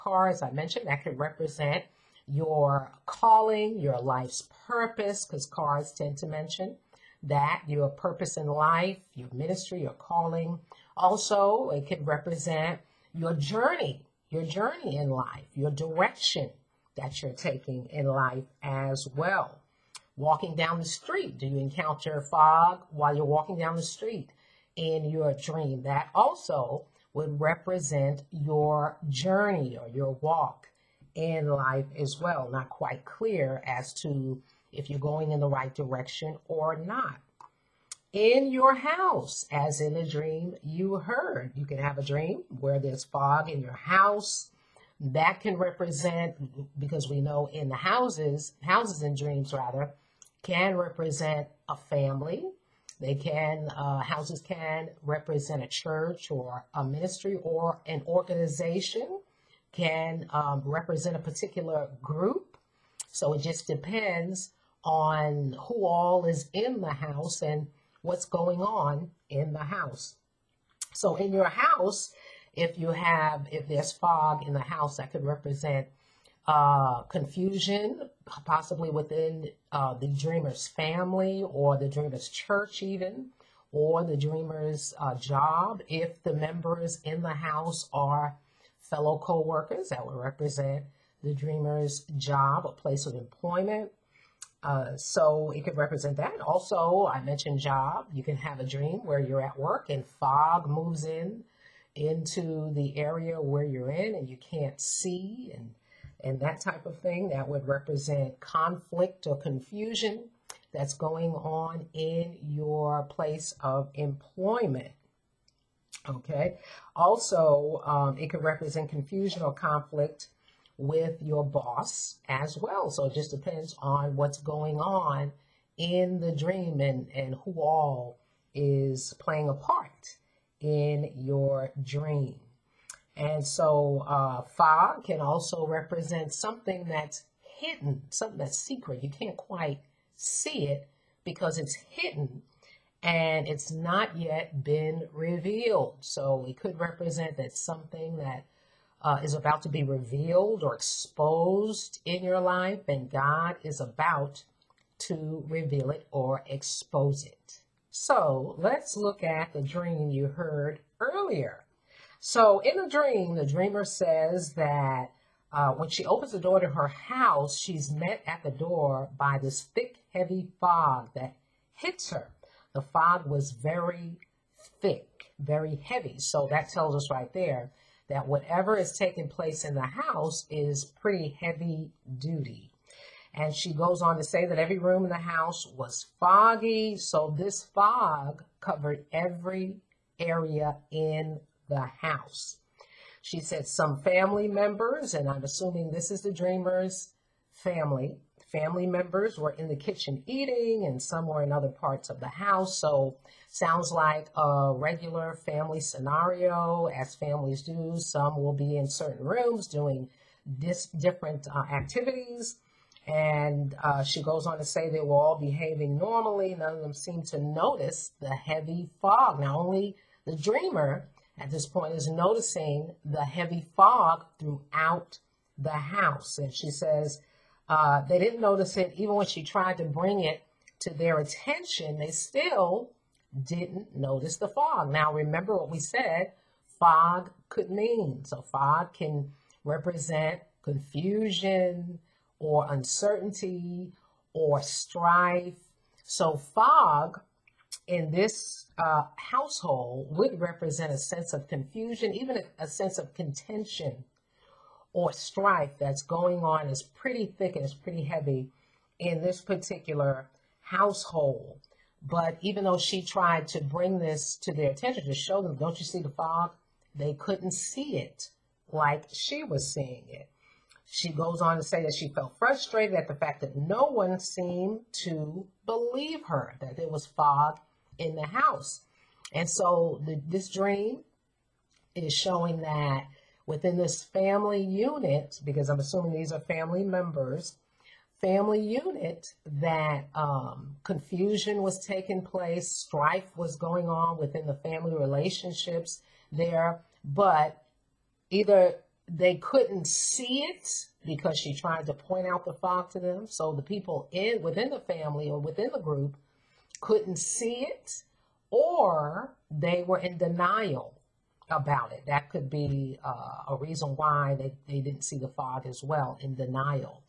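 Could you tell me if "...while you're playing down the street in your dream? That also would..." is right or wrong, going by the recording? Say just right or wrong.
wrong.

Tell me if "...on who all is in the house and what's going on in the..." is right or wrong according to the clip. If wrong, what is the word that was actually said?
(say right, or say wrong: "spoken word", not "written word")
right.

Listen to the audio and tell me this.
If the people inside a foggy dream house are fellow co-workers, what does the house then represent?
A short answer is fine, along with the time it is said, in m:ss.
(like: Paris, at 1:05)
The dreamer's job, at 1:31.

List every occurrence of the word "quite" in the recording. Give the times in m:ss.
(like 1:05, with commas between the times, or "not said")
0:32, 2:19.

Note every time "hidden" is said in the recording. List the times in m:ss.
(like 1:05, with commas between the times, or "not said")
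2:17, 2:21.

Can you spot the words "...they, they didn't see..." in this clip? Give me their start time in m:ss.
5:14.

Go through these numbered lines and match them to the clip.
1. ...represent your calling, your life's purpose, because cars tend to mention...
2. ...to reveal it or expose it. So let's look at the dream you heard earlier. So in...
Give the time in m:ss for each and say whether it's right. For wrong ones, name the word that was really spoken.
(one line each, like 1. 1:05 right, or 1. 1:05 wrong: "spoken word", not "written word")
1. 0:01 right
2. 2:34 right.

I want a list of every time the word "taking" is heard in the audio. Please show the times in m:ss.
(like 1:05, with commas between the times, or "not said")
0:17, 2:58, 4:51.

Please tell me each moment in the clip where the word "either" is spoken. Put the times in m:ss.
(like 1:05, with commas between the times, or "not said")
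4:58.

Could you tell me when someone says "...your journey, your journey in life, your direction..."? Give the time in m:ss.
0:13.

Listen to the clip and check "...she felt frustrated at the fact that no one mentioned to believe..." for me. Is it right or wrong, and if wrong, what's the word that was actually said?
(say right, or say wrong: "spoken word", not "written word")
wrong: "seemed", not "mentioned".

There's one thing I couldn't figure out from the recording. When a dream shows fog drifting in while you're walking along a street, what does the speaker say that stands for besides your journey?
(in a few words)
Your walk in life.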